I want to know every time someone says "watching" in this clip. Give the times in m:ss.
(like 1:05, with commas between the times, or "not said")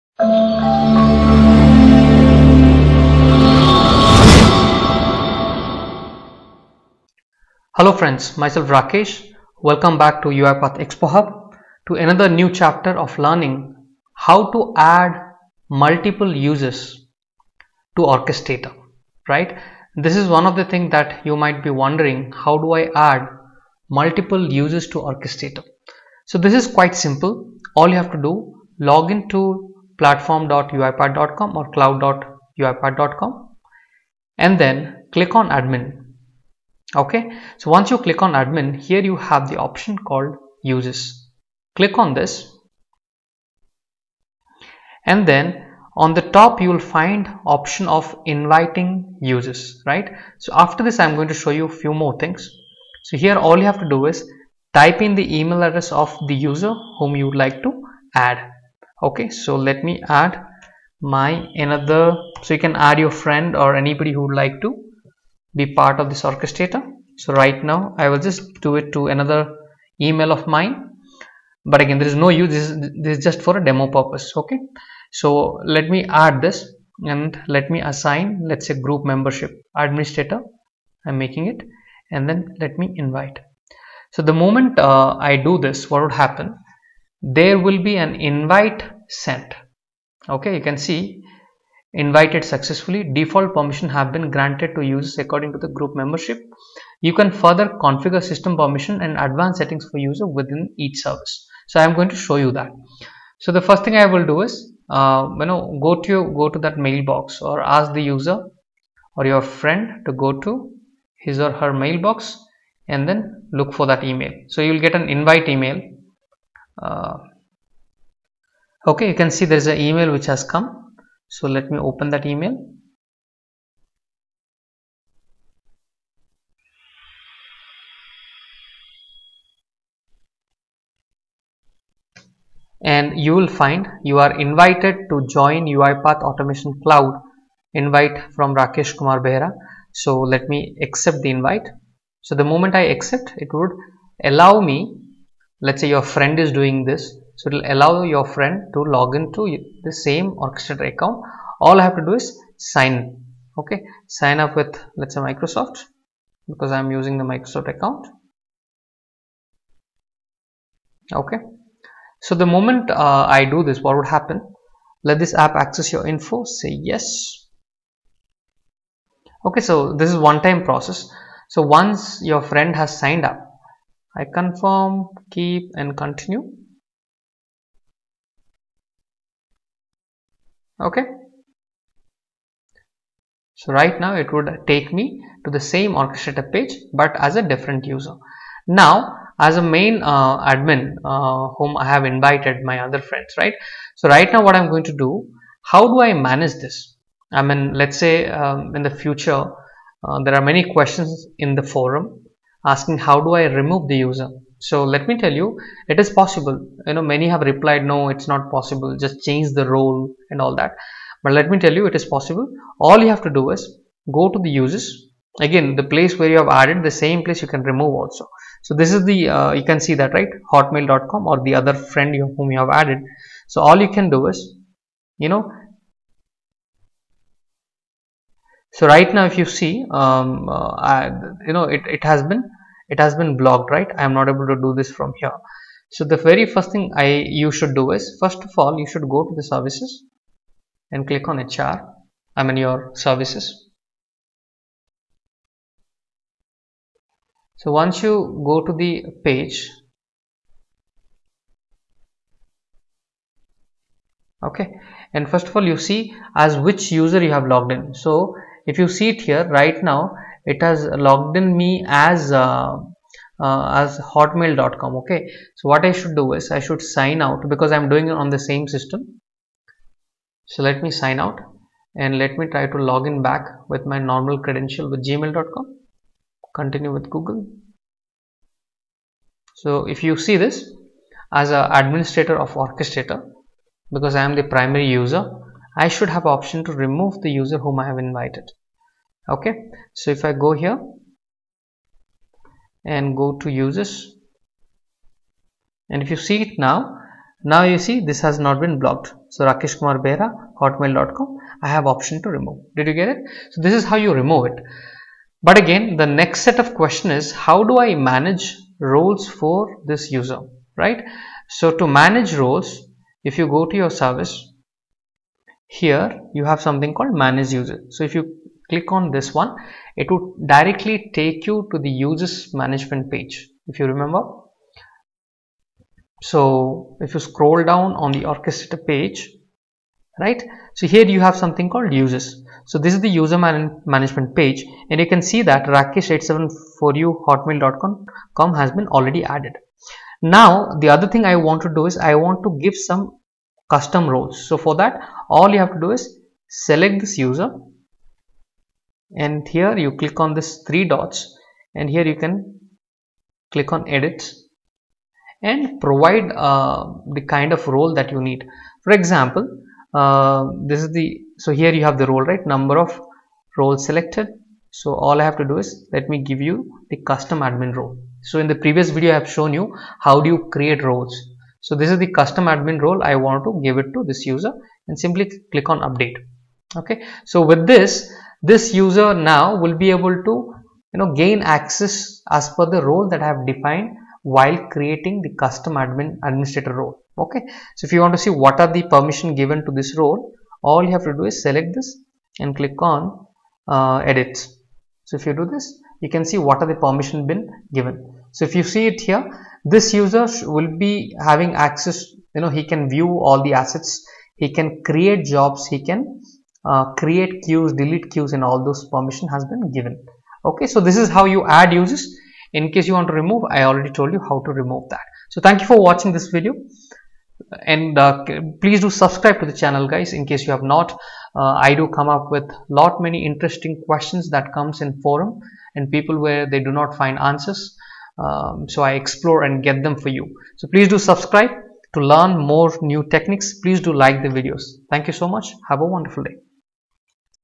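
6:55.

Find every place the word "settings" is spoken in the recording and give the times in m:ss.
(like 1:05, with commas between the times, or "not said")
1:39.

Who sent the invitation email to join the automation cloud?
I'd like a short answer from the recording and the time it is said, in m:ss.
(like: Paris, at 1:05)
Rakesh Kumar Behra, at 2:18.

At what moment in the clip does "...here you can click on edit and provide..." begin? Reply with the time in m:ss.
5:51.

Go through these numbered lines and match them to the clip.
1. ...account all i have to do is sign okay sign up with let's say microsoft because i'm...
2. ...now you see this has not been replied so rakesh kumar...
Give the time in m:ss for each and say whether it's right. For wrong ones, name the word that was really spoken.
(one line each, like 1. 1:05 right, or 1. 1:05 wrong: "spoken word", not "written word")
1. 2:30 right
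2. 4:57 wrong: "blocked", not "replied".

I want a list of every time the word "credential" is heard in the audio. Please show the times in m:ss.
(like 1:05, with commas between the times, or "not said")
4:34.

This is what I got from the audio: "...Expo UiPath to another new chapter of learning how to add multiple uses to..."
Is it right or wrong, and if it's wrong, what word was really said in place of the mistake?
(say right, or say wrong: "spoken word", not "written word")
wrong: "Hub", not "UiPath".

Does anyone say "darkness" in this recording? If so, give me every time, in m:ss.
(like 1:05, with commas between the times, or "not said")
not said.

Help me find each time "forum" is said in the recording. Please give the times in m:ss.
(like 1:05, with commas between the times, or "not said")
3:21, 7:05.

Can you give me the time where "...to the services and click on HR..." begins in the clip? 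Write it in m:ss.
3:59.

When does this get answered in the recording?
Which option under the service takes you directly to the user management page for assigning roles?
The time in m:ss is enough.
5:17.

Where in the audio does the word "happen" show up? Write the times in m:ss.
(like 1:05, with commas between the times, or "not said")
1:26, 2:44.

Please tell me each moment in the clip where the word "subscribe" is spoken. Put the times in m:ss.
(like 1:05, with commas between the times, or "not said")
6:58, 7:10.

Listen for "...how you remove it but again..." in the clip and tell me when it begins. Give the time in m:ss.
5:03.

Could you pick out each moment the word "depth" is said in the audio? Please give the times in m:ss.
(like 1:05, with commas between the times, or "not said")
not said.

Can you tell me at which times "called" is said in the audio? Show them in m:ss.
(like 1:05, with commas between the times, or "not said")
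0:40, 5:16, 5:31.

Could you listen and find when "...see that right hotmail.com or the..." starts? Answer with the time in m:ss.
3:39.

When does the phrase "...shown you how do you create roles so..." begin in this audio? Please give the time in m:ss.
6:09.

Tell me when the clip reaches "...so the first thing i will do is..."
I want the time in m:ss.
1:43.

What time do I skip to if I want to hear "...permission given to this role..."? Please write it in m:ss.
6:28.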